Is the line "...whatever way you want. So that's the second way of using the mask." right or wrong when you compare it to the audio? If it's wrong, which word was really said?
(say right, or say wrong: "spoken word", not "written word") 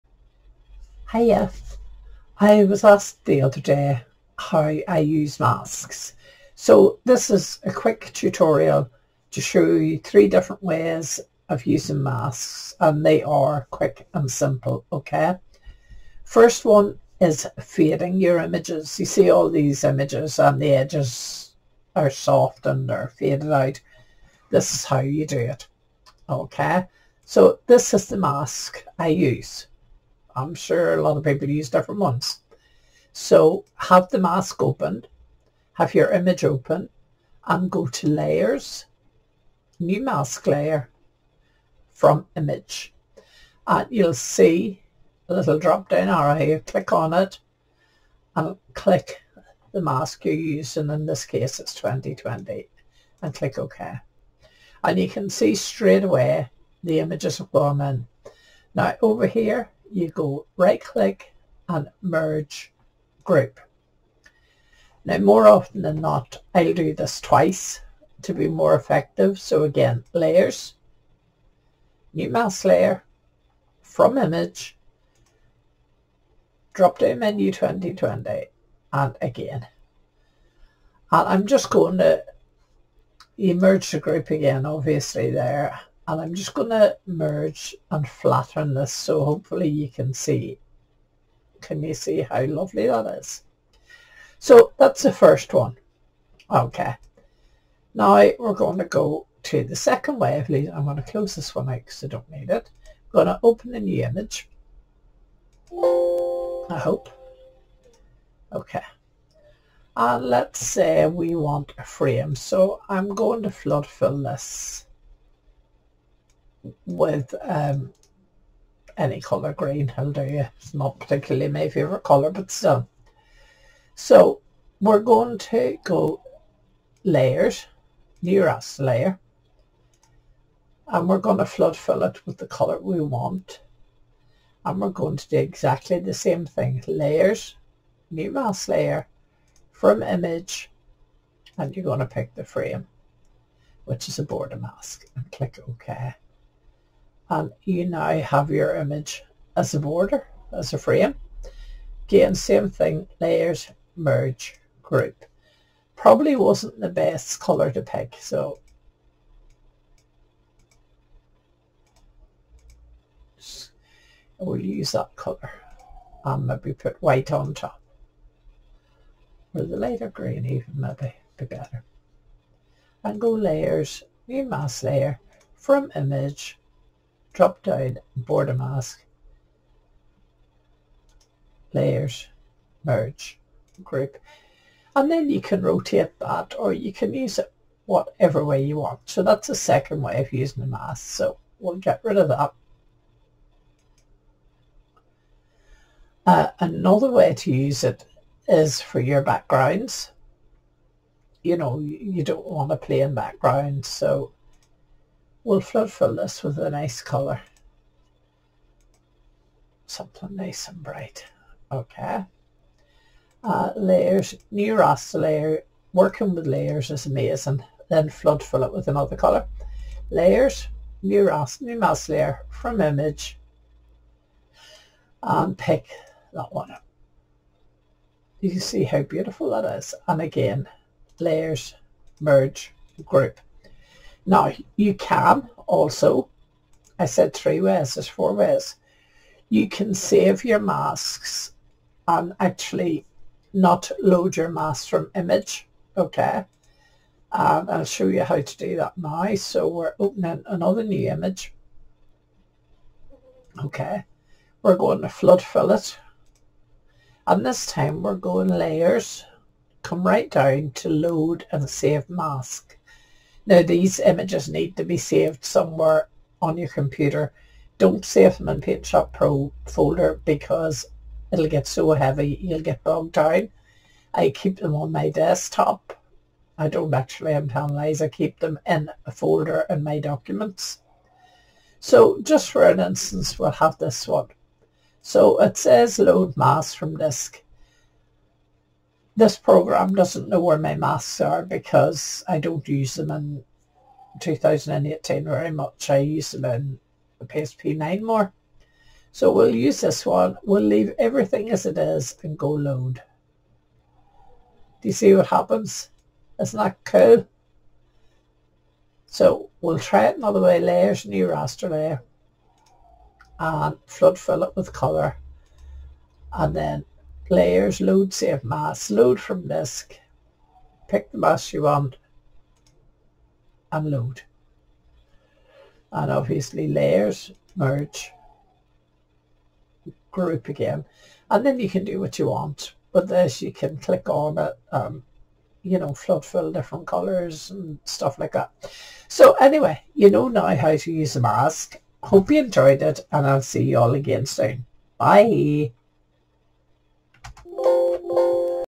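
right.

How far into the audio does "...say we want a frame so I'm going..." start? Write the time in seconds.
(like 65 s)
110 s.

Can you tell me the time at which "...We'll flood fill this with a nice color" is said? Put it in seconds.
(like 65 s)
205 s.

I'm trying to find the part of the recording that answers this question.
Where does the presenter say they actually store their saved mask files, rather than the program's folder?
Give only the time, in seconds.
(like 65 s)
279 s.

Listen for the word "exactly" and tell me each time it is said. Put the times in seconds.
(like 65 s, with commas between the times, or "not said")
135 s.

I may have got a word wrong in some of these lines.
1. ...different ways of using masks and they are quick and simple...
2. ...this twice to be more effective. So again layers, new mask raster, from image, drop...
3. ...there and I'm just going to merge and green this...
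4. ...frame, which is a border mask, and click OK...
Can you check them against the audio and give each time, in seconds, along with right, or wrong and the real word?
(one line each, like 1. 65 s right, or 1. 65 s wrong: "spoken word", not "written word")
1. 10 s right
2. 66 s wrong: "layer", not "raster"
3. 85 s wrong: "flatten", not "green"
4. 142 s right.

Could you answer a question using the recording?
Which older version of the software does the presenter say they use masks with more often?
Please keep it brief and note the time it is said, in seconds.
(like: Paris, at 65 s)
PSP9, at 297 s.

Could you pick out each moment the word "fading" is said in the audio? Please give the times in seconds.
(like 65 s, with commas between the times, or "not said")
17 s.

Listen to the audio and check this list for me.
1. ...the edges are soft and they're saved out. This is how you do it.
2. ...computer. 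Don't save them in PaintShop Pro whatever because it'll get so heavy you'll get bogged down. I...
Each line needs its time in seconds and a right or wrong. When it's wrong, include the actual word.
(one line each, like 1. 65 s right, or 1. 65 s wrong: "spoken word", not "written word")
1. 20 s wrong: "faded", not "saved"
2. 266 s wrong: "folder", not "whatever".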